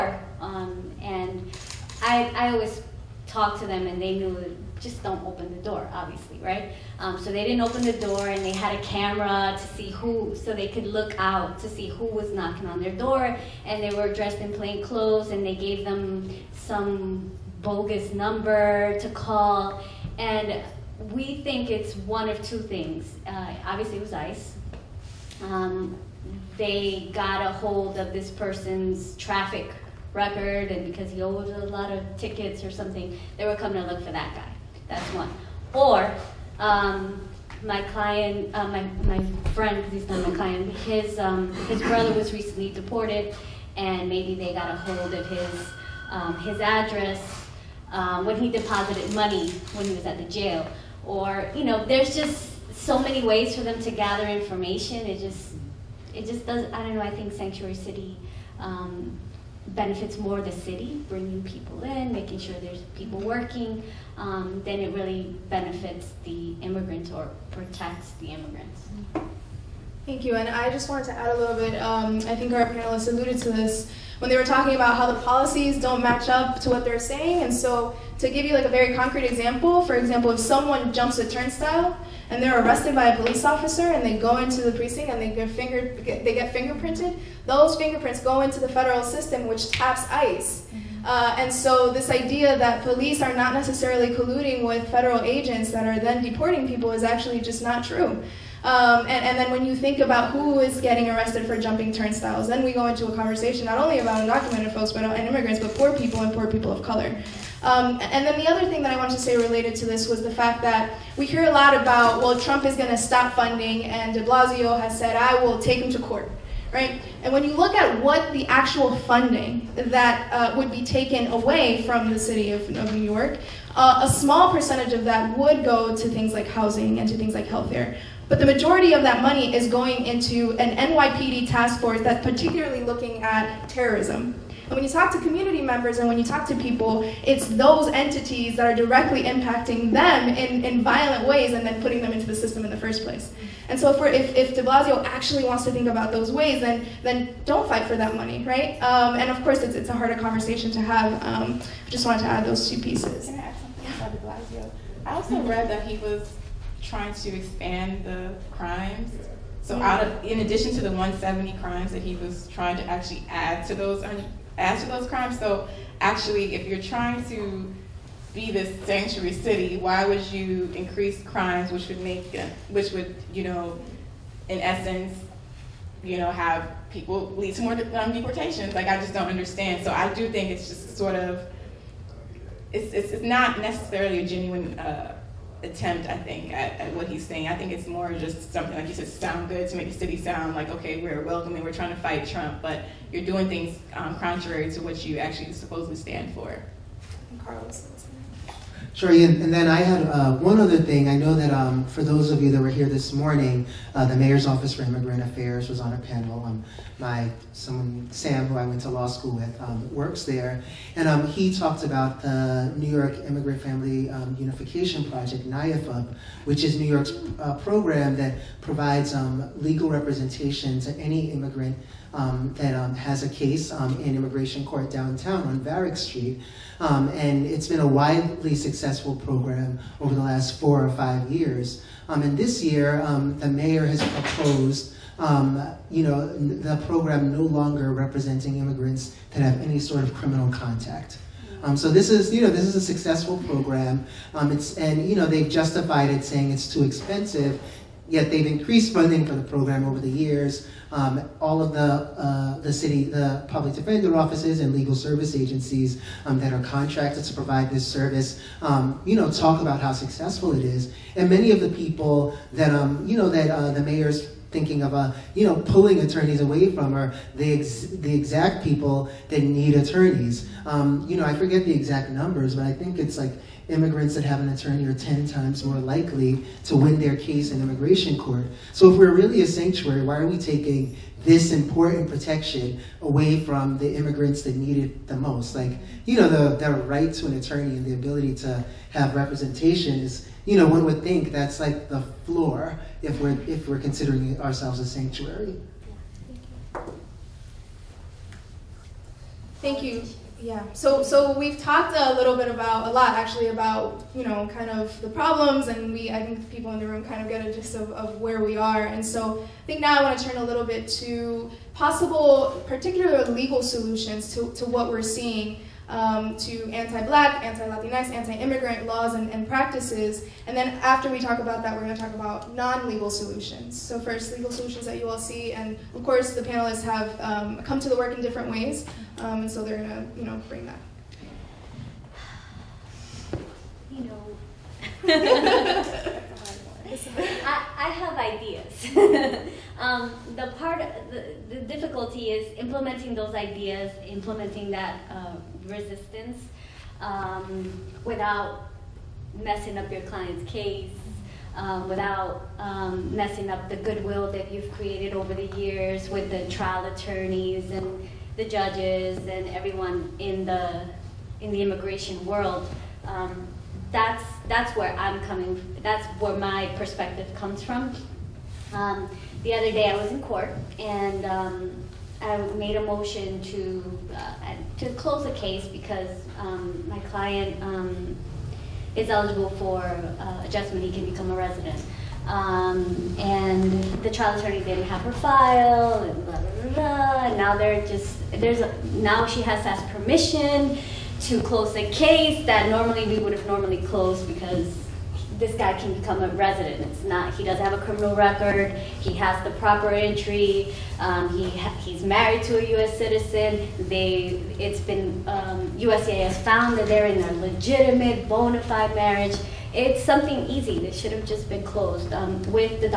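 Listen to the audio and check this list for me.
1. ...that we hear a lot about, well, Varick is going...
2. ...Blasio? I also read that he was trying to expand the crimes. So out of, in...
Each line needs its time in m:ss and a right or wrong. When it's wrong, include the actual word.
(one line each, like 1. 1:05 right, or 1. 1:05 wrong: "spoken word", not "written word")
1. 1:50 wrong: "Trump", not "Varick"
2. 2:34 right.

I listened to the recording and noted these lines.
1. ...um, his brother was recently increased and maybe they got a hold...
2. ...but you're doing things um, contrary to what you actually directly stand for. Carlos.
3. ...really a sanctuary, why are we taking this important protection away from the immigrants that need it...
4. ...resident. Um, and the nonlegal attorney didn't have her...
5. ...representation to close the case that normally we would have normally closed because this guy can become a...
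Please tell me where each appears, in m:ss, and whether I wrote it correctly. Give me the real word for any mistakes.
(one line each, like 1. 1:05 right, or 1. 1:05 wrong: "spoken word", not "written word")
1. 0:41 wrong: "deported", not "increased"
2. 3:12 wrong: "supposedly", not "directly"
3. 4:39 right
4. 6:21 wrong: "trial", not "nonlegal"
5. 6:29 wrong: "permission", not "representation".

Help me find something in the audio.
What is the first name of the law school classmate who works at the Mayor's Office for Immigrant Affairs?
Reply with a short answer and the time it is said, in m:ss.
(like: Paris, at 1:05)
Sam, at 3:28.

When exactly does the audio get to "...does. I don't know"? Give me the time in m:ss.
0:56.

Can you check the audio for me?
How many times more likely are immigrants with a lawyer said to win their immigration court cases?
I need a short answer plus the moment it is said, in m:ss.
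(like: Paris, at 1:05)
10, at 4:34.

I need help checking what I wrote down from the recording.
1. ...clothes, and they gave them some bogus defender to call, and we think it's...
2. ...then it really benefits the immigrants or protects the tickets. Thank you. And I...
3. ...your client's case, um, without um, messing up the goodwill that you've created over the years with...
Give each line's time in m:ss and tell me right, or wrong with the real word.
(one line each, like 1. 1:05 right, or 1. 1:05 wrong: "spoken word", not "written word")
1. 0:14 wrong: "number", not "defender"
2. 1:04 wrong: "immigrants", not "tickets"
3. 5:49 right.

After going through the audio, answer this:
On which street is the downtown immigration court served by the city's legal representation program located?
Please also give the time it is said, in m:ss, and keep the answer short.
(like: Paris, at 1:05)
Varick Street, at 3:45.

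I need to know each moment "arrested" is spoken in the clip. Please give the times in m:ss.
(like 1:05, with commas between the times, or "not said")
1:22, 1:41.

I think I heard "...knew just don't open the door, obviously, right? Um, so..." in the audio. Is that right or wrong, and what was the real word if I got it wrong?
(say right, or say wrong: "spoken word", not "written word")
right.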